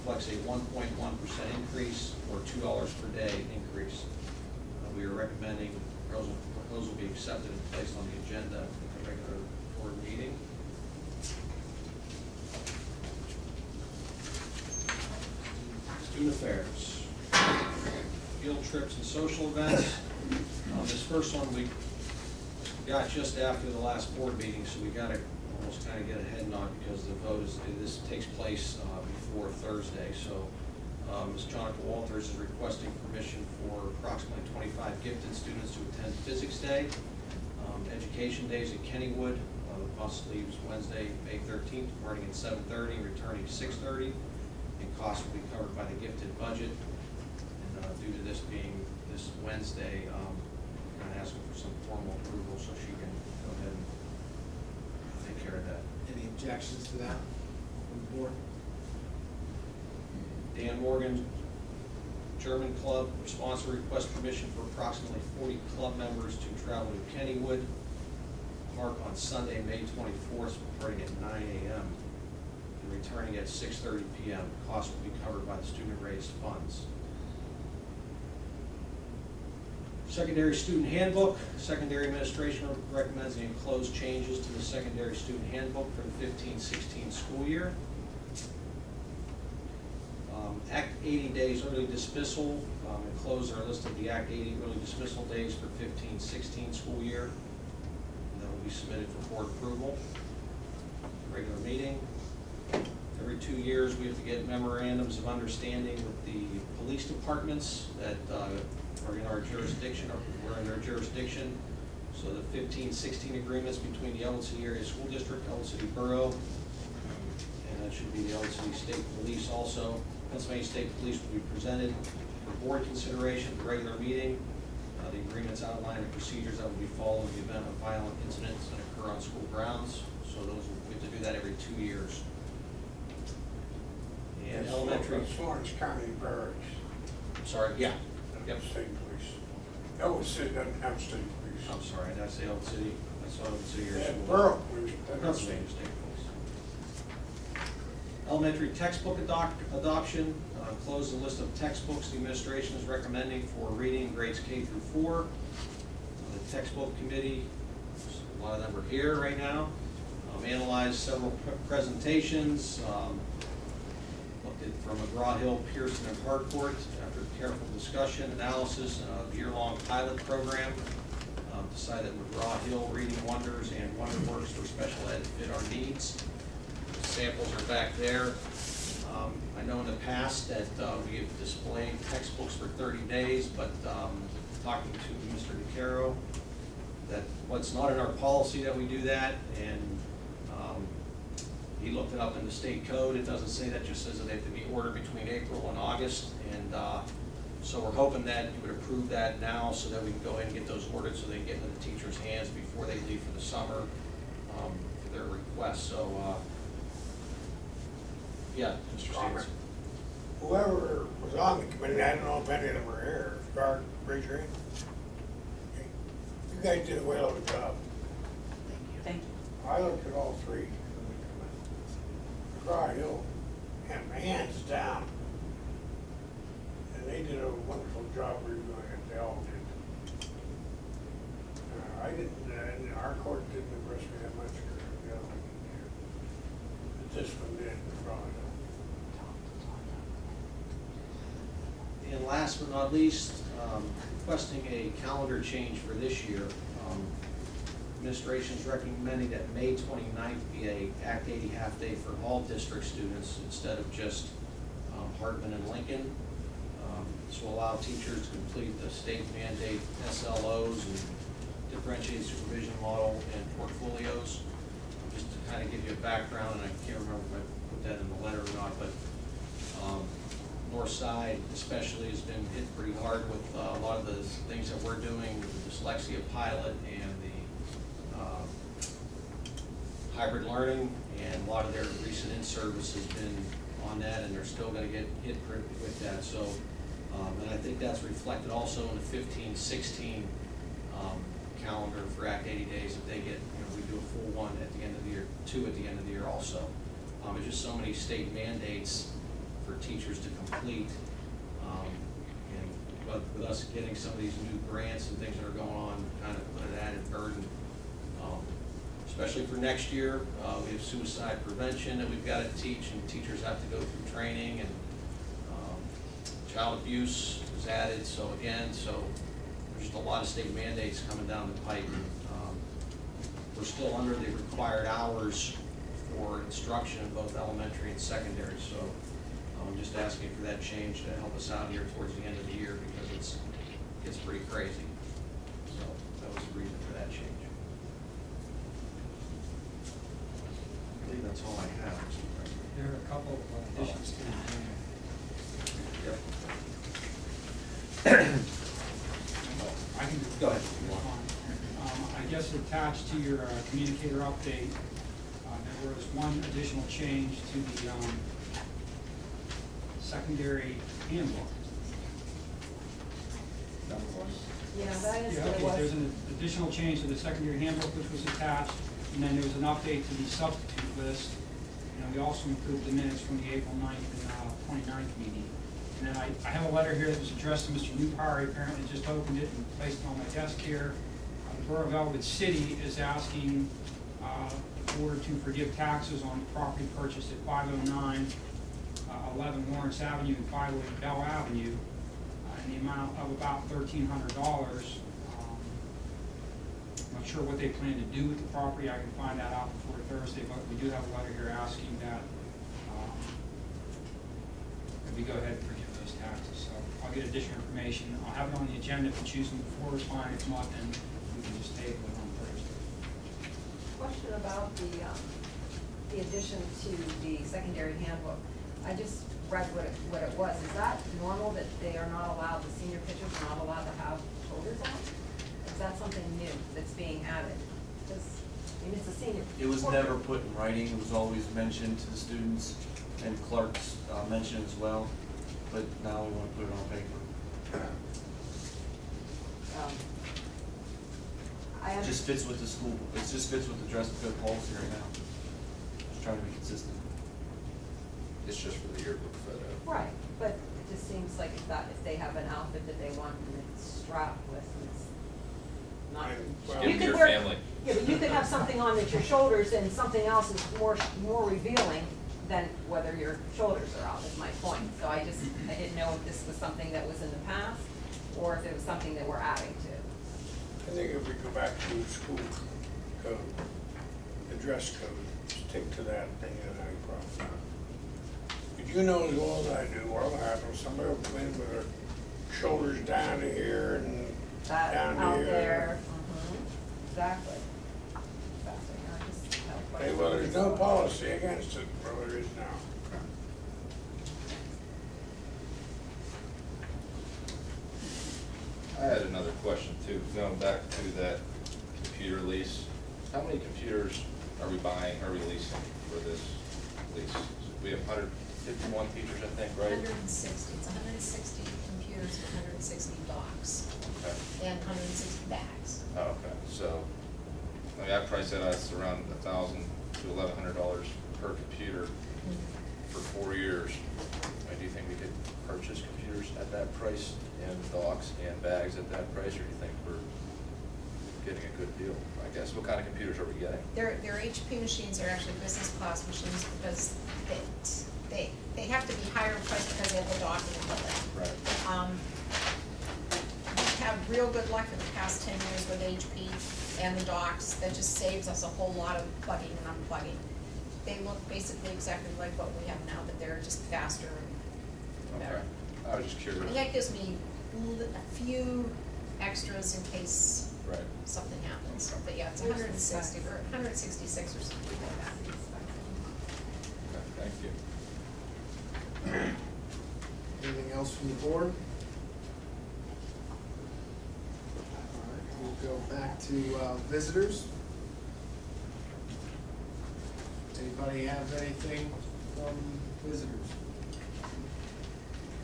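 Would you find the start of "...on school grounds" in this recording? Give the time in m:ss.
2:09.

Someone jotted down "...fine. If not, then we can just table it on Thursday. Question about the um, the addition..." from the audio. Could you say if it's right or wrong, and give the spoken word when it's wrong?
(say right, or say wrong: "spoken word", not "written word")
right.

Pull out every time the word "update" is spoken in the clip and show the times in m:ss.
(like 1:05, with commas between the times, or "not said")
5:54, 6:09.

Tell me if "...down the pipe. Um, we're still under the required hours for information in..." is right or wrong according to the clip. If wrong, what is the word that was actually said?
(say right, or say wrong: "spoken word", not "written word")
wrong: "instruction", not "information".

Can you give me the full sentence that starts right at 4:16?
Um, this will allow teachers to complete the state mandate SLOs and differentiated supervision model and portfolios.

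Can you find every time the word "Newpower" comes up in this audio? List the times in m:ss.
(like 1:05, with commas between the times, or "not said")
6:17.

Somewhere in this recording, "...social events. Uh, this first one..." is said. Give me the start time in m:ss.
0:19.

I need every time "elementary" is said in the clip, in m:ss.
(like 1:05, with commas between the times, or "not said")
2:14, 2:28, 5:27.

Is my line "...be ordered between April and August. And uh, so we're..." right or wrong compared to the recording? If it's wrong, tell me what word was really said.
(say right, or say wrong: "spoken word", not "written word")
right.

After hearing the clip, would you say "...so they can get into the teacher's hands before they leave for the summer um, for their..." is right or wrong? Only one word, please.
right.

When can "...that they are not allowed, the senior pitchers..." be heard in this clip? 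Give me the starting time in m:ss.
7:01.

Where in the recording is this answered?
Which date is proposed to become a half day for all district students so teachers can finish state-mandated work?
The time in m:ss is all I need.
4:09.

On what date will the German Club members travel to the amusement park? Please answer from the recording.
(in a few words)
Sunday, May 24th.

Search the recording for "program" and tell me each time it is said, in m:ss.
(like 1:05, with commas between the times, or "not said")
2:50.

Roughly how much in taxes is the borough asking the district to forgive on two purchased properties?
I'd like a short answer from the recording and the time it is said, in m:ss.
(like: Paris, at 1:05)
$1,300, at 6:33.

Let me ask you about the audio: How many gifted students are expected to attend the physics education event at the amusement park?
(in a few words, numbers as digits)
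25.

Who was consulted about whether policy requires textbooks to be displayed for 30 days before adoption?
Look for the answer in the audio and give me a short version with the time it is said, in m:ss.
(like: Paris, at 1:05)
Mr. DeCaro, at 3:05.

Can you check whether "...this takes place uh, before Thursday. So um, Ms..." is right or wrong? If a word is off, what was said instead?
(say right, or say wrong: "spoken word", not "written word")
right.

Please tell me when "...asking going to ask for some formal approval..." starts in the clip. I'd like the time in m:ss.
0:51.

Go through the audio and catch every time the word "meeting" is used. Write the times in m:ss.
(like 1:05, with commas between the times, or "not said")
0:10, 0:24, 1:41, 2:03, 6:15.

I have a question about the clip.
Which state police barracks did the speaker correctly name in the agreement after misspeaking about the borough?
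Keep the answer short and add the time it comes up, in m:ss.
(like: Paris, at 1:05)
Florence County, at 2:15.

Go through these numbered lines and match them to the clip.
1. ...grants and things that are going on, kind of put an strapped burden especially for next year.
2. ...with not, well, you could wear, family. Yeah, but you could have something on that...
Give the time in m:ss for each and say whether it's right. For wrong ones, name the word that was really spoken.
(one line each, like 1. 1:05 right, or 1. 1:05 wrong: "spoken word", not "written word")
1. 5:04 wrong: "added", not "strapped"
2. 7:34 right.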